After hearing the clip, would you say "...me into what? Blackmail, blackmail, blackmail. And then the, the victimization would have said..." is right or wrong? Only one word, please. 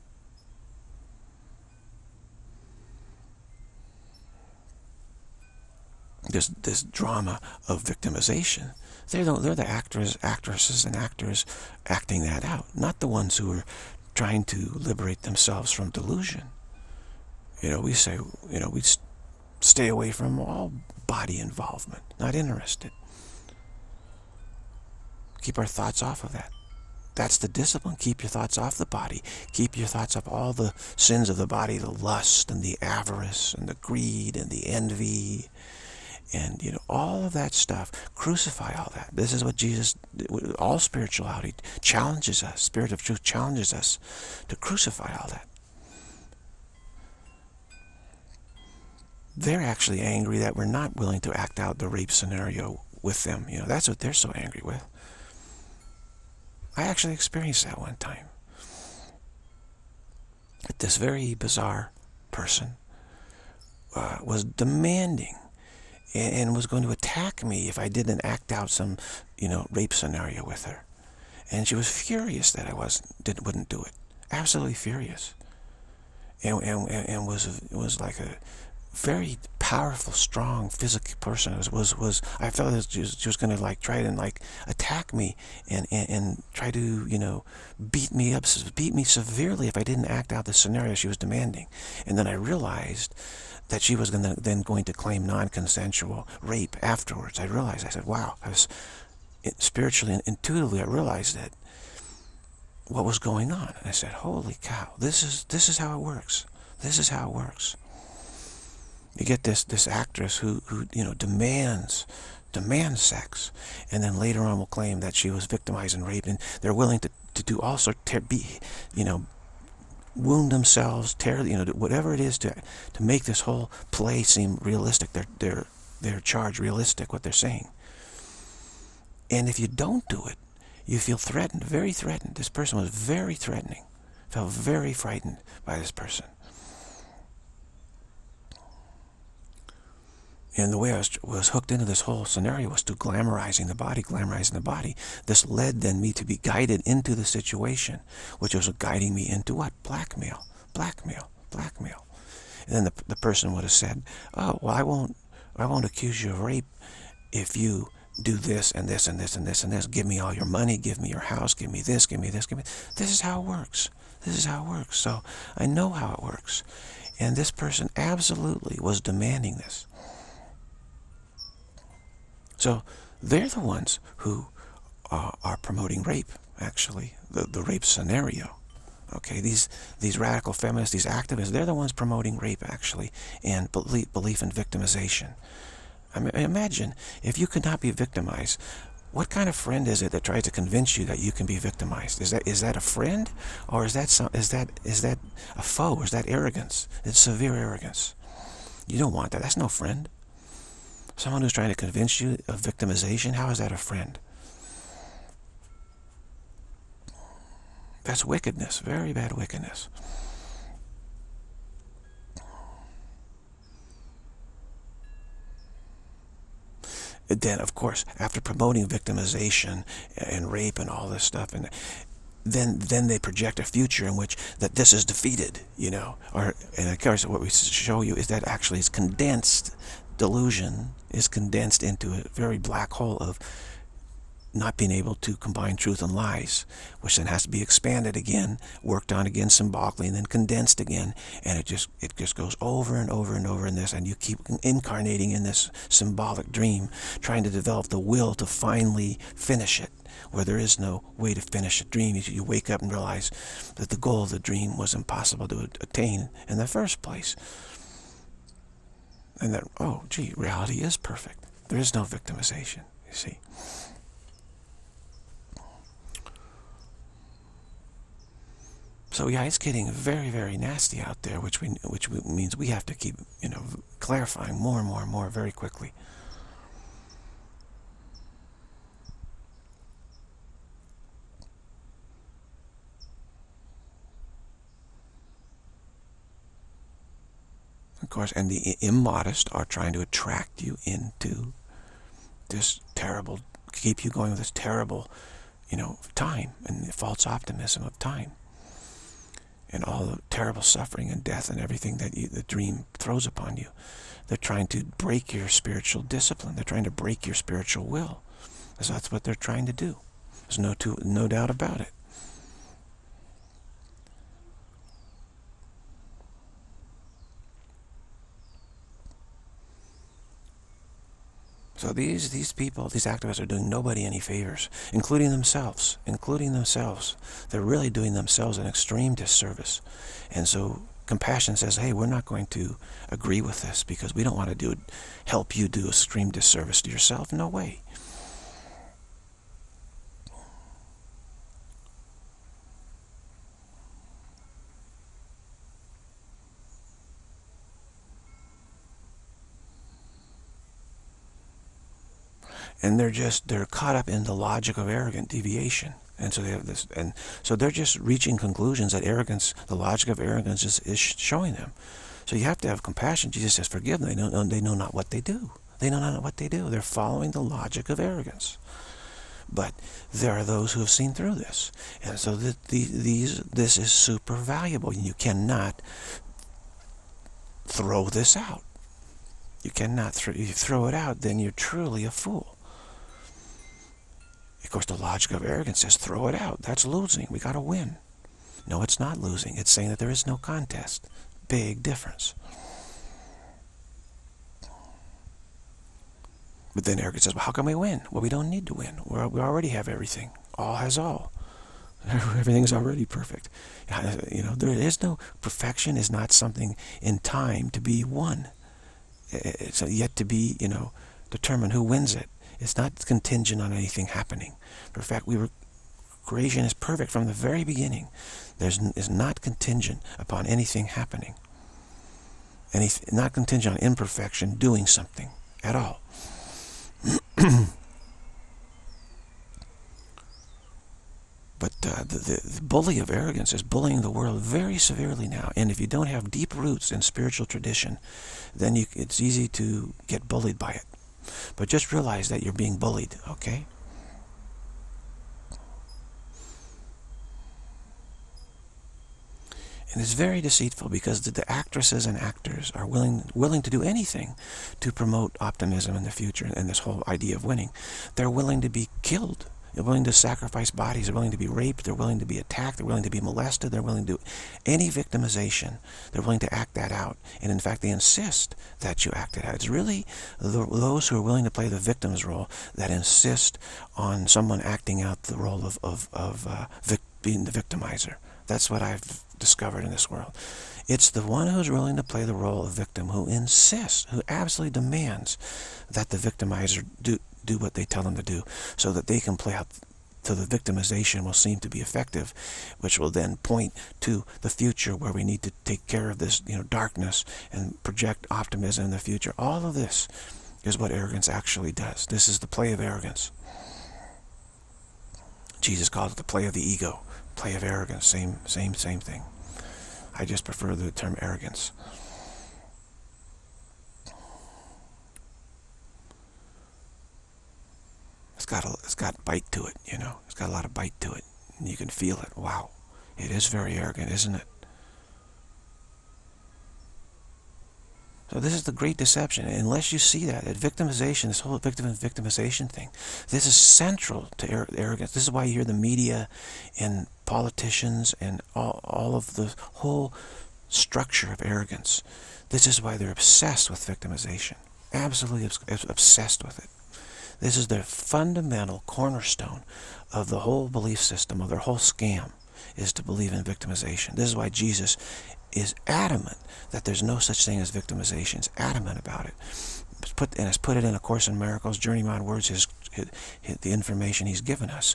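wrong.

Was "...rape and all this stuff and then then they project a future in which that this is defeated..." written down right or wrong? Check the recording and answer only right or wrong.
right.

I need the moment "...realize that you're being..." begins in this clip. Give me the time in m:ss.
7:21.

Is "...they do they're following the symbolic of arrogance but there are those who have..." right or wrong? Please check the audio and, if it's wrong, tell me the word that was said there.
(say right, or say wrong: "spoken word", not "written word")
wrong: "logic", not "symbolic".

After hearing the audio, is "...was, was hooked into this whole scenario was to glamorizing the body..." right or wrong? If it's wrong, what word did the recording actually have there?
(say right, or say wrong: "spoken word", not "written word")
right.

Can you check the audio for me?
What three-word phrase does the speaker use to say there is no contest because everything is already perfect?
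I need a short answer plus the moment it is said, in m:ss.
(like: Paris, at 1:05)
All has all, at 6:40.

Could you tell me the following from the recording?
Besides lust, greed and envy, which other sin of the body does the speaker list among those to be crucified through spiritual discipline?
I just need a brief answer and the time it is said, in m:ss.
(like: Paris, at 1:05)
Avarice, at 0:32.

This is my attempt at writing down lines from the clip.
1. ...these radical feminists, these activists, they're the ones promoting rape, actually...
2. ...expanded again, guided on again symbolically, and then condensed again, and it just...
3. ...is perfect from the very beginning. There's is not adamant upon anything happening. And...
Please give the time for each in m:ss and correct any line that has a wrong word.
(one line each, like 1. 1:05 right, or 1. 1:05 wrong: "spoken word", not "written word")
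1. 2:59 right
2. 3:57 wrong: "worked", not "guided"
3. 6:56 wrong: "contingent", not "adamant".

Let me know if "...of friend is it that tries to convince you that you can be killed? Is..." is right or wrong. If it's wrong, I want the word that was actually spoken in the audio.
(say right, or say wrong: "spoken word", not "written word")
wrong: "victimized", not "killed".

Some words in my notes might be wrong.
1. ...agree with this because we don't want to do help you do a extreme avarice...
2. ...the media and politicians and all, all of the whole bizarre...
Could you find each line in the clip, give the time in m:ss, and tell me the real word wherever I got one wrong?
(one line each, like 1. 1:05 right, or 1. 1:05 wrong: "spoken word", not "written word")
1. 5:33 wrong: "disservice", not "avarice"
2. 8:55 wrong: "structure", not "bizarre".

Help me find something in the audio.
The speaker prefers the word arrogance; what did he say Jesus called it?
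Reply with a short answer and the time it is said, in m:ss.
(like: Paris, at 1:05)
The play of the ego, at 8:26.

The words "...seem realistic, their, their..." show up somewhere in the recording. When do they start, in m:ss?
2:04.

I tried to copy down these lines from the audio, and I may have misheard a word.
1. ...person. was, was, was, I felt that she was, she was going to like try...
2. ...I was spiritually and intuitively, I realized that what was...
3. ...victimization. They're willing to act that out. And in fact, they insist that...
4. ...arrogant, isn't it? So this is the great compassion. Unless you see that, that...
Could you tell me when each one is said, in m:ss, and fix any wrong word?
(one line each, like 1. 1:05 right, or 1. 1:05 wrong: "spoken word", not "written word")
1. 1:21 right
2. 1:38 right
3. 7:44 right
4. 8:43 wrong: "deception", not "compassion".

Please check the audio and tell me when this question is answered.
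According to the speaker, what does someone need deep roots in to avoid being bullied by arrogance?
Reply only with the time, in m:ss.
7:17.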